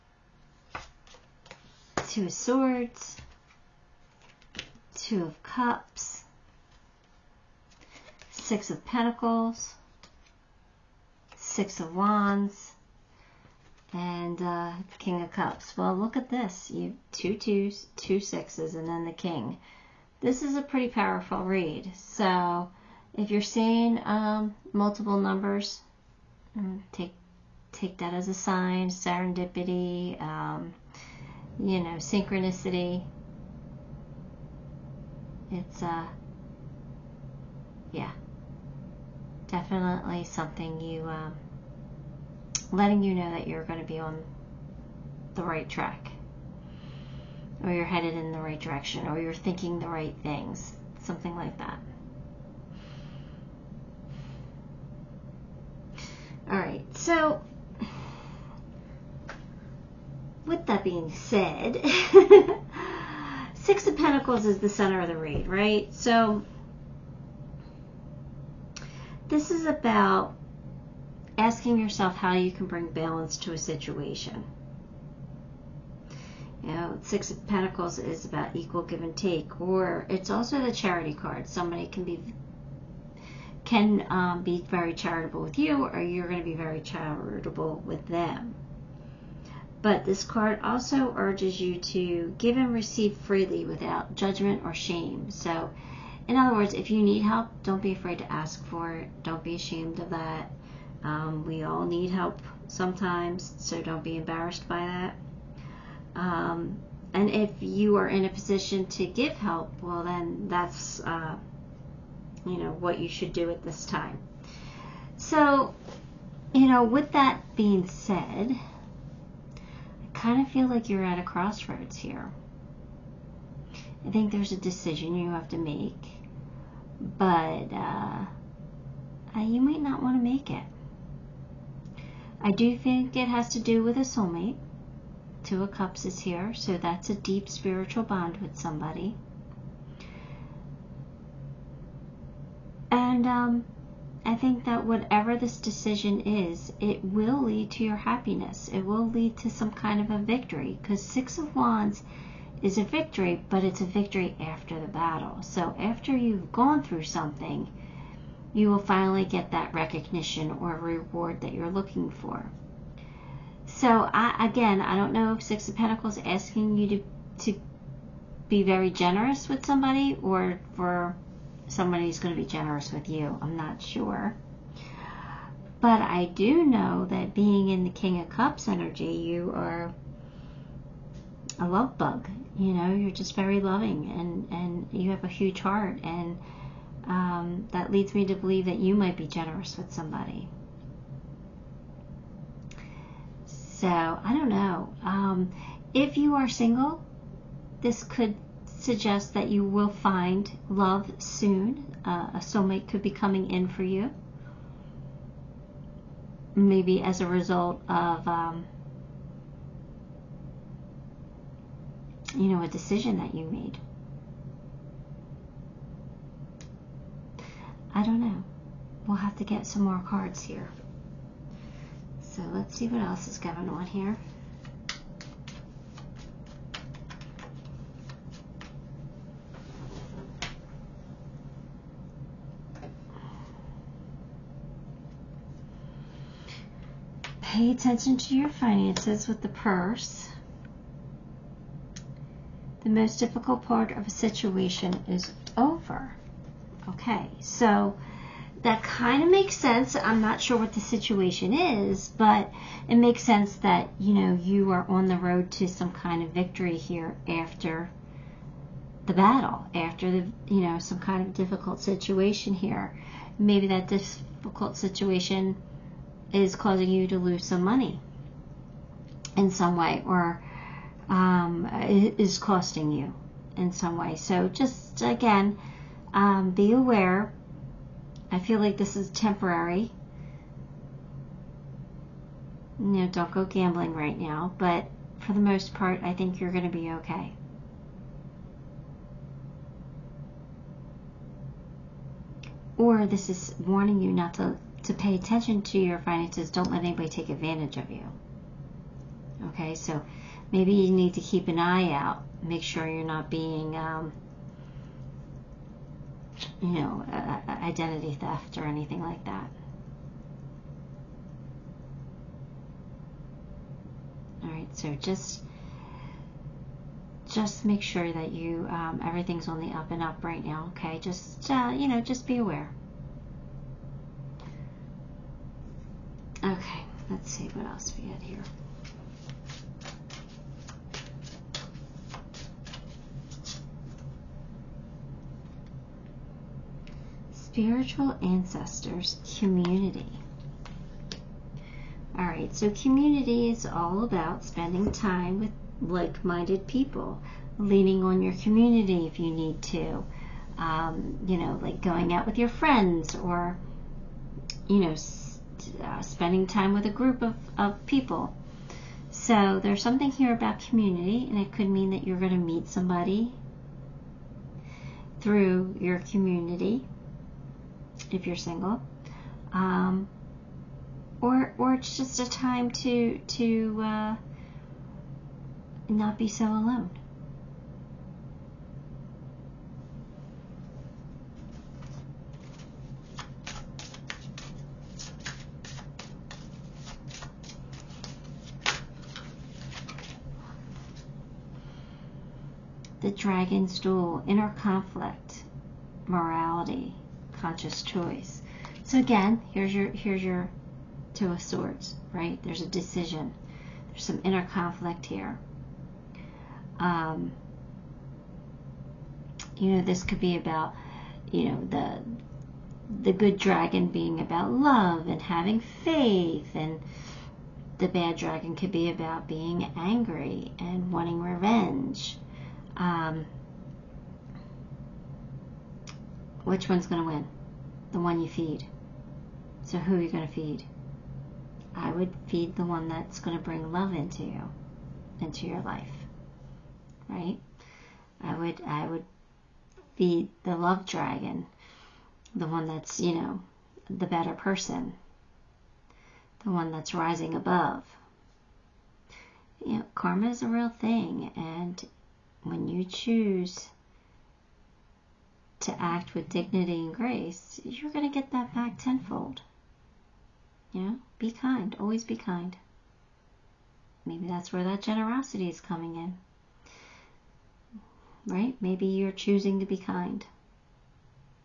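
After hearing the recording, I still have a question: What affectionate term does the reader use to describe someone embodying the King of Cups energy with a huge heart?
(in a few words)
love bug.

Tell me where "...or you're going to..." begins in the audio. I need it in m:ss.
1:25.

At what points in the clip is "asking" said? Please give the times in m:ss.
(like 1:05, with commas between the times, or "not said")
1:11, 2:46.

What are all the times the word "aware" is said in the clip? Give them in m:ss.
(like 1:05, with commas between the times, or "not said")
4:36, 5:22.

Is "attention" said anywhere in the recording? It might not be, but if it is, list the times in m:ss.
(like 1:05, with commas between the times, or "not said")
3:57, 4:55.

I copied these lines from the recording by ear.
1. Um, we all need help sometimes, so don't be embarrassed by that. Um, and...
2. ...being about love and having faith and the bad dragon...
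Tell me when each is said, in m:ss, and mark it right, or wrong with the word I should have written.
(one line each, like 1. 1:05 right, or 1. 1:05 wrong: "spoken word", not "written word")
1. 1:41 right
2. 6:53 right.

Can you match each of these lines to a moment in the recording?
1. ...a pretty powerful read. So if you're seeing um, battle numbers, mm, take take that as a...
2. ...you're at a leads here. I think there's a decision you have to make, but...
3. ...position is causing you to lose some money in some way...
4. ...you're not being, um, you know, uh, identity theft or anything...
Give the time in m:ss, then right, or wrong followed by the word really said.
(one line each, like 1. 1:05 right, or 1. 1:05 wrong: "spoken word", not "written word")
1. 0:20 wrong: "multiple", not "battle"
2. 2:00 wrong: "crossroads", not "leads"
3. 4:24 wrong: "situation", not "position"
4. 5:02 right.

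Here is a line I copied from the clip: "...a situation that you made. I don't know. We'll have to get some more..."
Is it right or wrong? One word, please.
wrong.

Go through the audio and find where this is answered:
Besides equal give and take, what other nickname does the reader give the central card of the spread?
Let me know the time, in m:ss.
1:20.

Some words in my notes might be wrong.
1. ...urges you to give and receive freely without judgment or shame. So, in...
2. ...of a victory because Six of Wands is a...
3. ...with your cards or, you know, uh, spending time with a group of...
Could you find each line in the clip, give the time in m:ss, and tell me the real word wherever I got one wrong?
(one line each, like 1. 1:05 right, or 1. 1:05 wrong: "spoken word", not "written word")
1. 1:31 right
2. 2:29 right
3. 5:52 wrong: "friends", not "cards".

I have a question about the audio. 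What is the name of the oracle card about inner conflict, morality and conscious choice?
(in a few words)
The Dragon's Duel.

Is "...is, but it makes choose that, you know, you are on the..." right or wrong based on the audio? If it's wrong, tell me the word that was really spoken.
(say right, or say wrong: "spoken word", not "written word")
wrong: "sense", not "choose".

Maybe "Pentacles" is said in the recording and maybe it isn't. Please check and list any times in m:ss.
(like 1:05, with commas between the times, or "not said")
0:08, 1:03, 1:17, 2:45.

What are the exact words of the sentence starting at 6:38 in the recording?
So again, here's your here's your two of swords, right?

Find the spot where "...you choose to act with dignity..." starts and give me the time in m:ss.
7:32.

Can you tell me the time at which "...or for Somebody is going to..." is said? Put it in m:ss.
2:50.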